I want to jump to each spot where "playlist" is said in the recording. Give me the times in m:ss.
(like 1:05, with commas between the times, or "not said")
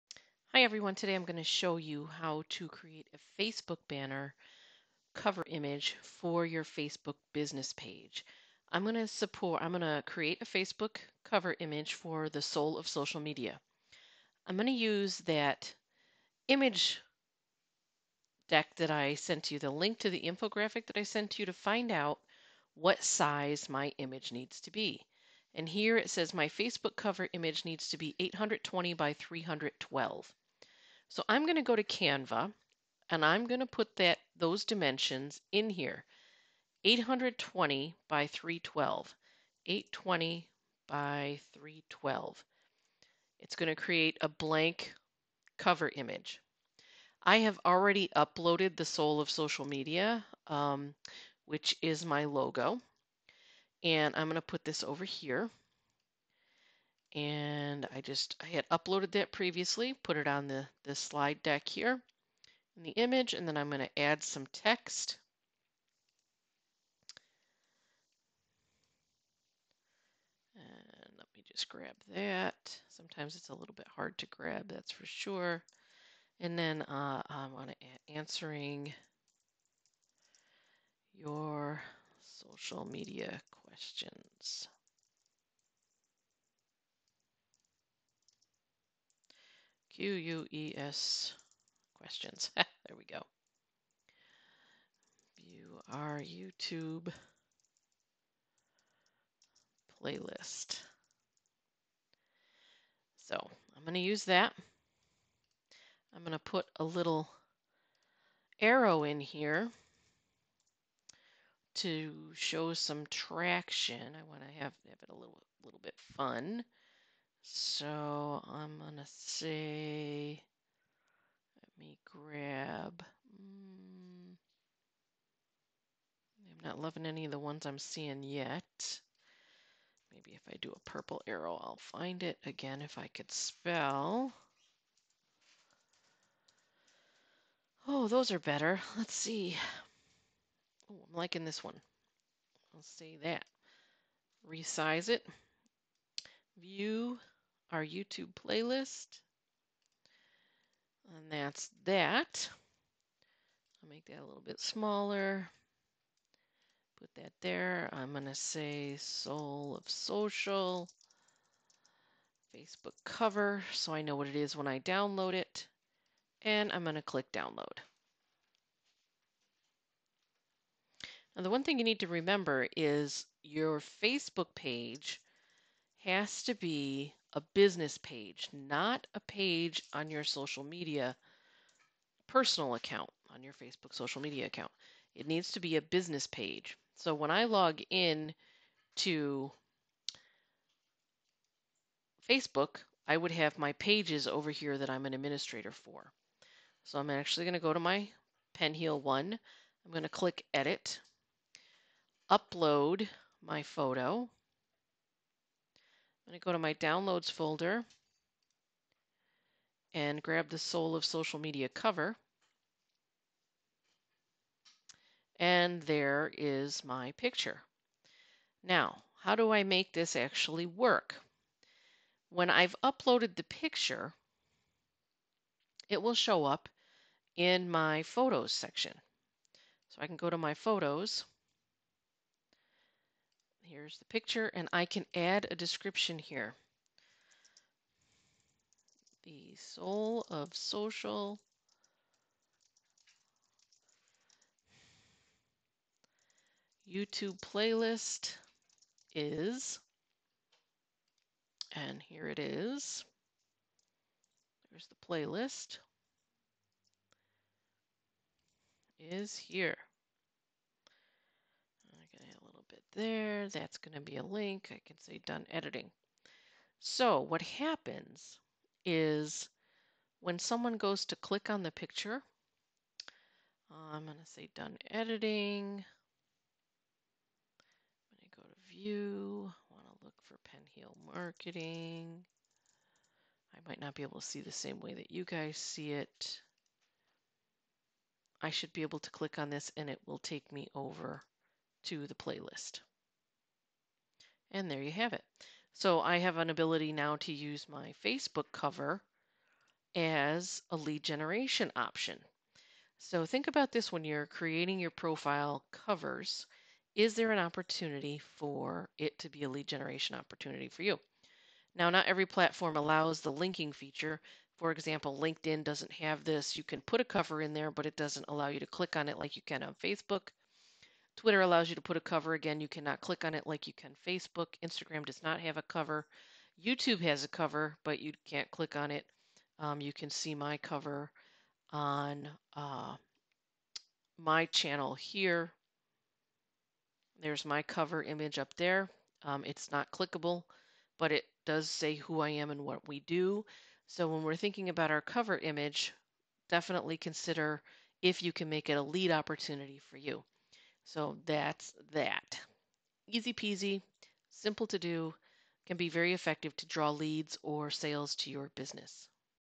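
1:40, 2:28, 4:07, 4:15, 4:52.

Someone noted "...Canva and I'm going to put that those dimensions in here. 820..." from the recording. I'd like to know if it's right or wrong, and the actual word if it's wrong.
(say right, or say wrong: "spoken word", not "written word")
right.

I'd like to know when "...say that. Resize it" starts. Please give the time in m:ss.
2:22.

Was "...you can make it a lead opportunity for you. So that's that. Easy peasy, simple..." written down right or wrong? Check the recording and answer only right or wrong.
right.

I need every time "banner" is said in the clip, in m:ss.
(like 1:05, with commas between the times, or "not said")
0:03.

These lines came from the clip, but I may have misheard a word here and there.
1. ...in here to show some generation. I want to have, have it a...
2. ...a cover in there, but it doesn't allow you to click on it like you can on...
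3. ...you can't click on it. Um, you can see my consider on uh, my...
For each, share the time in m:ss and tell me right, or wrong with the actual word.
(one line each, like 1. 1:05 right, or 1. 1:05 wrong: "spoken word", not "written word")
1. 1:49 wrong: "traction", not "generation"
2. 5:17 right
3. 5:27 wrong: "cover", not "consider".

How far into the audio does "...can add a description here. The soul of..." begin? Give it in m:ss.
3:54.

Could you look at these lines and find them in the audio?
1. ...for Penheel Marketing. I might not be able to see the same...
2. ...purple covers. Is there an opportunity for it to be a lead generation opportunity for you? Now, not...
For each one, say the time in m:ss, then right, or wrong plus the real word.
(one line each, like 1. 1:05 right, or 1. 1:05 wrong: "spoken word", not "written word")
1. 4:40 right
2. 5:04 wrong: "profile", not "purple".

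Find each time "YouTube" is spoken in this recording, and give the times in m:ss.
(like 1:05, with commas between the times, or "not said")
1:36, 2:27, 4:06, 5:26.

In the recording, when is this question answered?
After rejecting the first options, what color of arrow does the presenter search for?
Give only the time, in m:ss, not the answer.
2:10.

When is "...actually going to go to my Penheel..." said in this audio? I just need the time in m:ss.
3:17.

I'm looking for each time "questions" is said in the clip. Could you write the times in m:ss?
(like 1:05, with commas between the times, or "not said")
1:23, 1:31.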